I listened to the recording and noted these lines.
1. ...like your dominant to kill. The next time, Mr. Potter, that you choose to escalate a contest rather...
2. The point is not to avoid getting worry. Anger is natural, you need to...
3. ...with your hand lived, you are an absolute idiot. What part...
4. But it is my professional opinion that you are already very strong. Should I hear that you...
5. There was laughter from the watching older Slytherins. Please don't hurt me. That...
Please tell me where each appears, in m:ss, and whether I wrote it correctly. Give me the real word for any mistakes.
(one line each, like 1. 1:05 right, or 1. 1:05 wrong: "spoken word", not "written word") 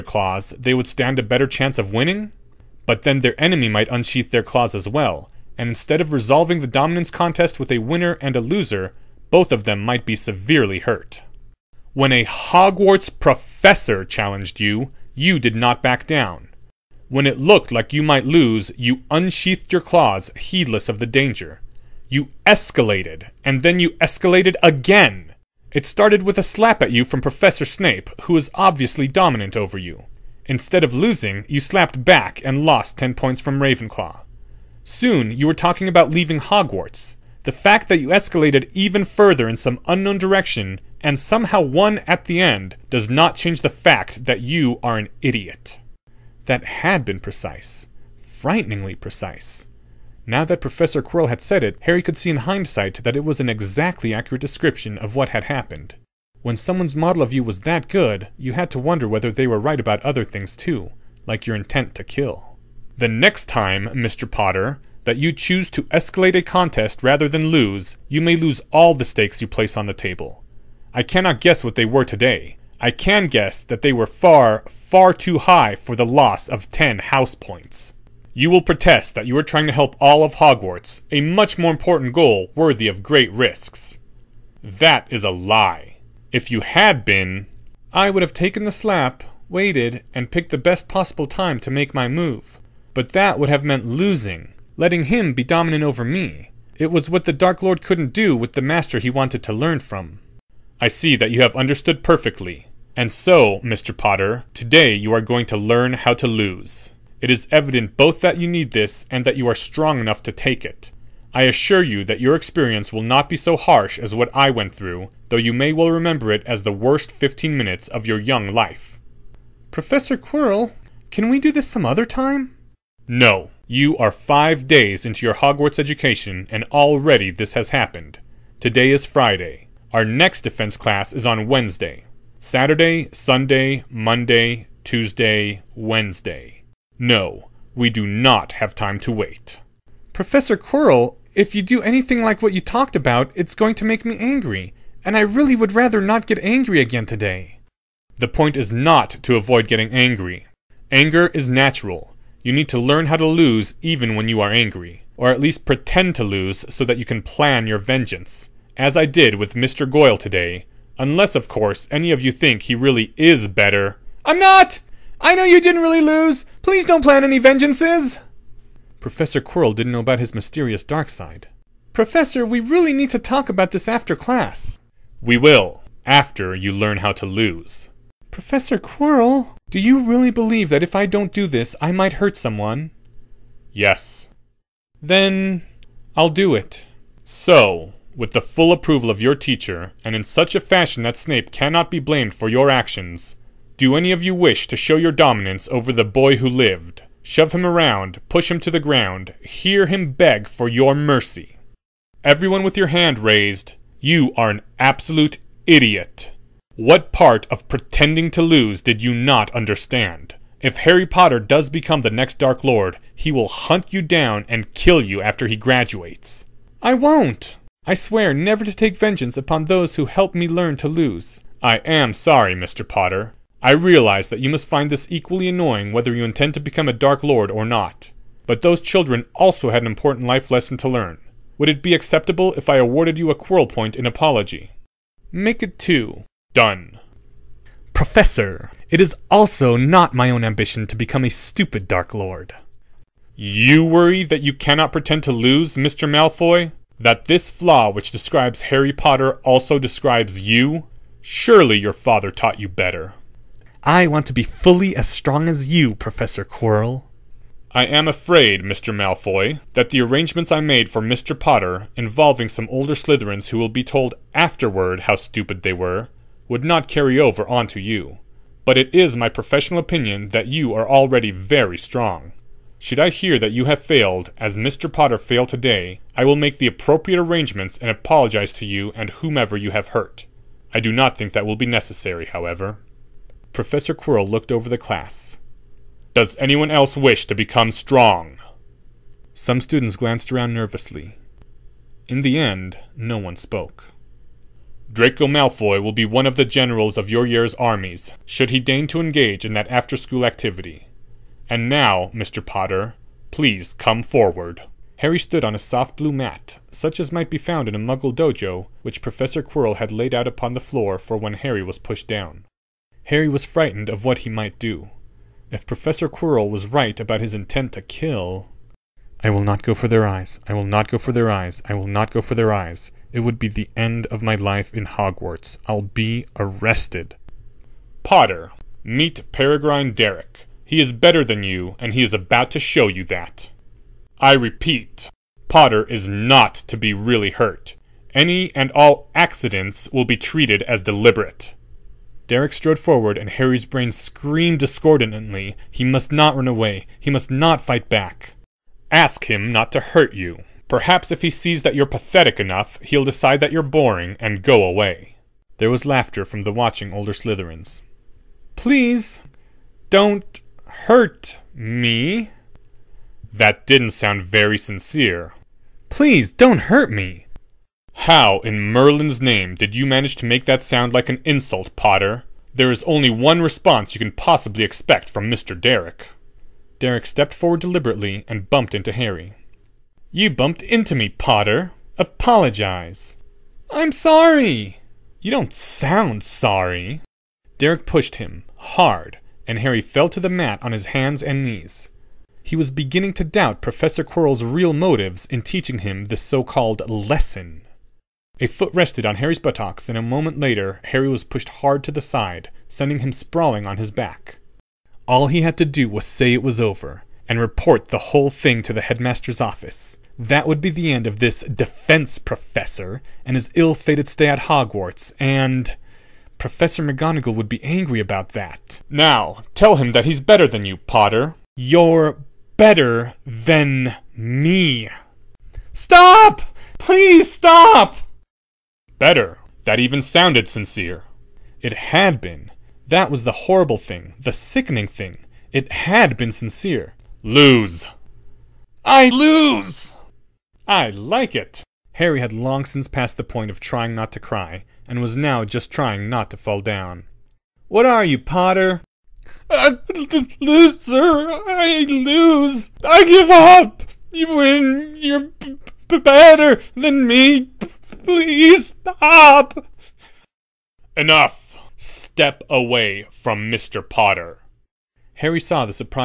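1. 1:01 wrong: "intent", not "dominant"
2. 2:28 wrong: "angry", not "worry"
3. 3:22 wrong: "raised", not "lived"
4. 4:28 right
5. 5:55 right.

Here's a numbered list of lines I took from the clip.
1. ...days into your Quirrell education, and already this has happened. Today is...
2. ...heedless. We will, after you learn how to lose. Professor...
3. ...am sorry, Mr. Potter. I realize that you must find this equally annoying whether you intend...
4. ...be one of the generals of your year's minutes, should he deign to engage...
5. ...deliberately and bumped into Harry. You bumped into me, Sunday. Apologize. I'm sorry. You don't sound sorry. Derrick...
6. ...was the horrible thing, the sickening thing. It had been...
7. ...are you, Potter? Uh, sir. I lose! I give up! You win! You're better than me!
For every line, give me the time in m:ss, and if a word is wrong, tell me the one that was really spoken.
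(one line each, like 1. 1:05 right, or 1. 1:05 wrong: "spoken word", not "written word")
1. 2:04 wrong: "Hogwarts", not "Quirrell"
2. 2:54 wrong: "class", not "heedless"
3. 3:41 right
4. 4:55 wrong: "armies", not "minutes"
5. 6:17 wrong: "Potter", not "Sunday"
6. 7:13 right
7. 7:27 right.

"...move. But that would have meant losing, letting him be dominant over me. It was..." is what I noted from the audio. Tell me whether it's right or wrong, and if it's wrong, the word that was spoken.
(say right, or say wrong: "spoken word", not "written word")
right.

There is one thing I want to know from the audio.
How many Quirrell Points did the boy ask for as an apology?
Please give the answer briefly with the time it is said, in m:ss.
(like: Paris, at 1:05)
2, at 3:55.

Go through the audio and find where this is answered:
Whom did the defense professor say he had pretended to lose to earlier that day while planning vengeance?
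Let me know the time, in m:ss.
2:39.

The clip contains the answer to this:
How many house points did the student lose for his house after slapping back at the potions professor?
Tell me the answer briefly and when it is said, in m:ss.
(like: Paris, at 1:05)
10, at 0:32.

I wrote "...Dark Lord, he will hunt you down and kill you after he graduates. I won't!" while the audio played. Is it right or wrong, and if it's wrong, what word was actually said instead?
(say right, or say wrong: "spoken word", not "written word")
right.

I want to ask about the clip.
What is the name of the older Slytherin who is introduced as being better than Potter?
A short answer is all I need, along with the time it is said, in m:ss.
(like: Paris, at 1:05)
Peregrine Derrick, at 5:29.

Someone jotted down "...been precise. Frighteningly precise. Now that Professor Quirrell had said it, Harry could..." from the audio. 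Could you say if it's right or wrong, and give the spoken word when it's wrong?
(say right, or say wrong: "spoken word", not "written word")
right.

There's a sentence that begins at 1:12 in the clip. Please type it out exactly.
I can guess that they were far, far too high for the loss of 10 house points.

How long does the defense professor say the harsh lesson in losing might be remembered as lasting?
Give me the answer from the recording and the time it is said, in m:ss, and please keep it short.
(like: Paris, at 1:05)
15 minutes, at 1:57.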